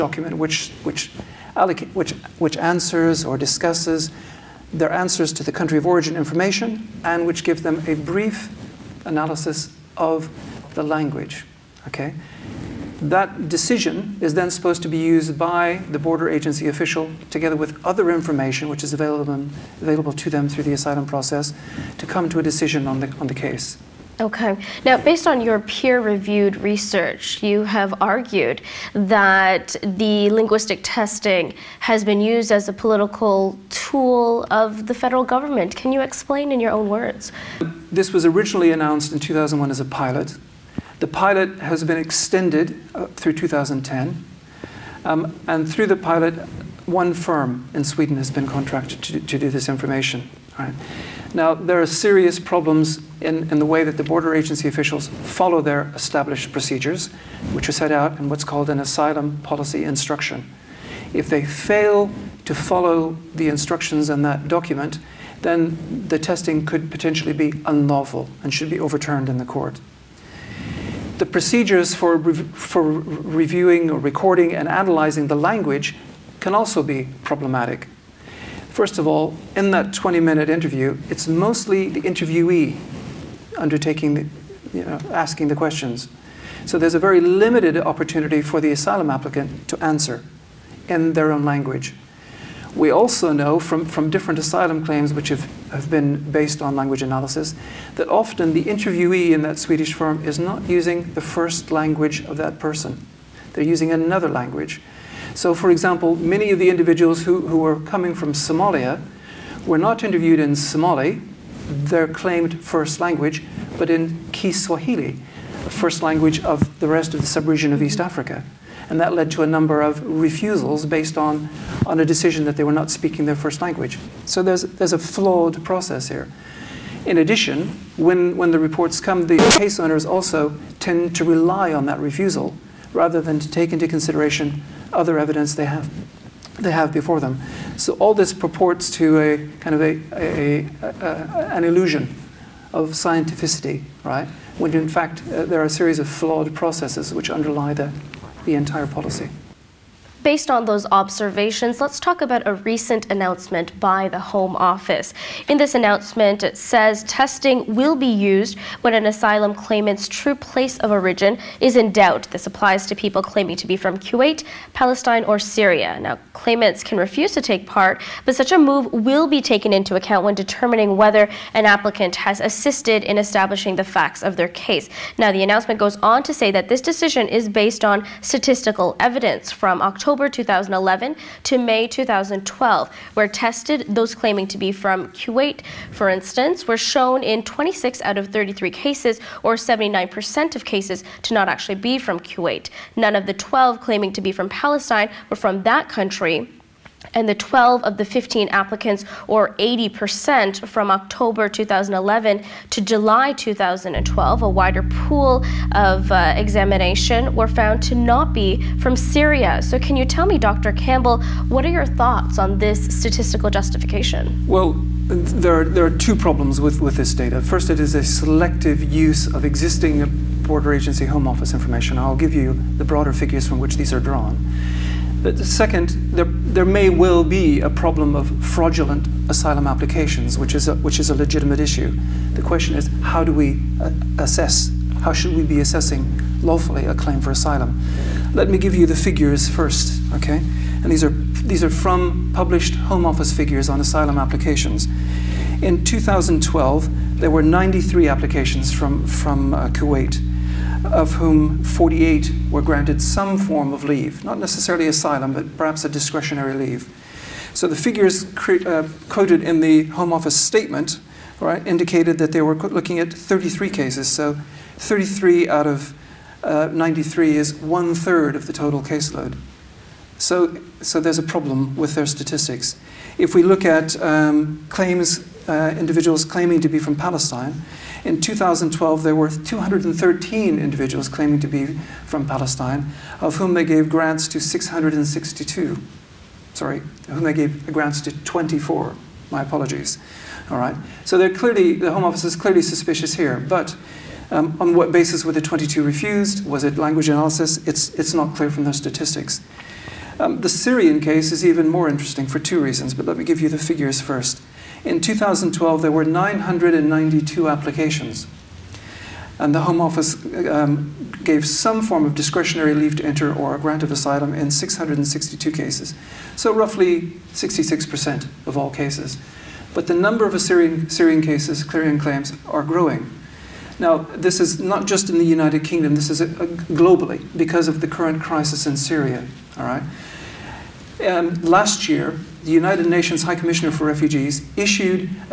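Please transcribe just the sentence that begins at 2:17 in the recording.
So all this purports to a kind of a, a, a, an illusion of scientificity, right?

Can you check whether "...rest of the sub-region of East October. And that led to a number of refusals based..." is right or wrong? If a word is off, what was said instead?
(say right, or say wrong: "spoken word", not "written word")
wrong: "Africa", not "October".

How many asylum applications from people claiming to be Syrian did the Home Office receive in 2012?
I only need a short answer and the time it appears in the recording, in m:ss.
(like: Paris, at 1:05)
992, at 5:06.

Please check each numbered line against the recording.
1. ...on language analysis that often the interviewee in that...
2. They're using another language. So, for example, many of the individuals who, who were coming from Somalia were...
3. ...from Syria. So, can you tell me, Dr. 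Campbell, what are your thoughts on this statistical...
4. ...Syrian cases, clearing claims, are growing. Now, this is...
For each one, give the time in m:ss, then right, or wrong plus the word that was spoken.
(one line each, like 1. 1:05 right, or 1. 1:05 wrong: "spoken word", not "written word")
1. 1:36 right
2. 1:43 right
3. 3:28 right
4. 5:20 right.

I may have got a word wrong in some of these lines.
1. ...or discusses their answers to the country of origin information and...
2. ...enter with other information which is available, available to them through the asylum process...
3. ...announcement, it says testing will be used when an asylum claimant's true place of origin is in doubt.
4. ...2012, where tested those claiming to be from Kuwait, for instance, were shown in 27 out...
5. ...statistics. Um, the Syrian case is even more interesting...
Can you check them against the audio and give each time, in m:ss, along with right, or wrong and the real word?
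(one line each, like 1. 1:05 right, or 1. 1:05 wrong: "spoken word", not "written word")
1. 0:03 right
2. 0:17 wrong: "together", not "enter"
3. 2:35 right
4. 3:01 wrong: "26", not "27"
5. 4:58 right.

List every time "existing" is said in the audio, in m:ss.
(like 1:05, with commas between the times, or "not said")
3:39.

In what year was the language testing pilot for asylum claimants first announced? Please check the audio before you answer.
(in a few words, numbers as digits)
2001.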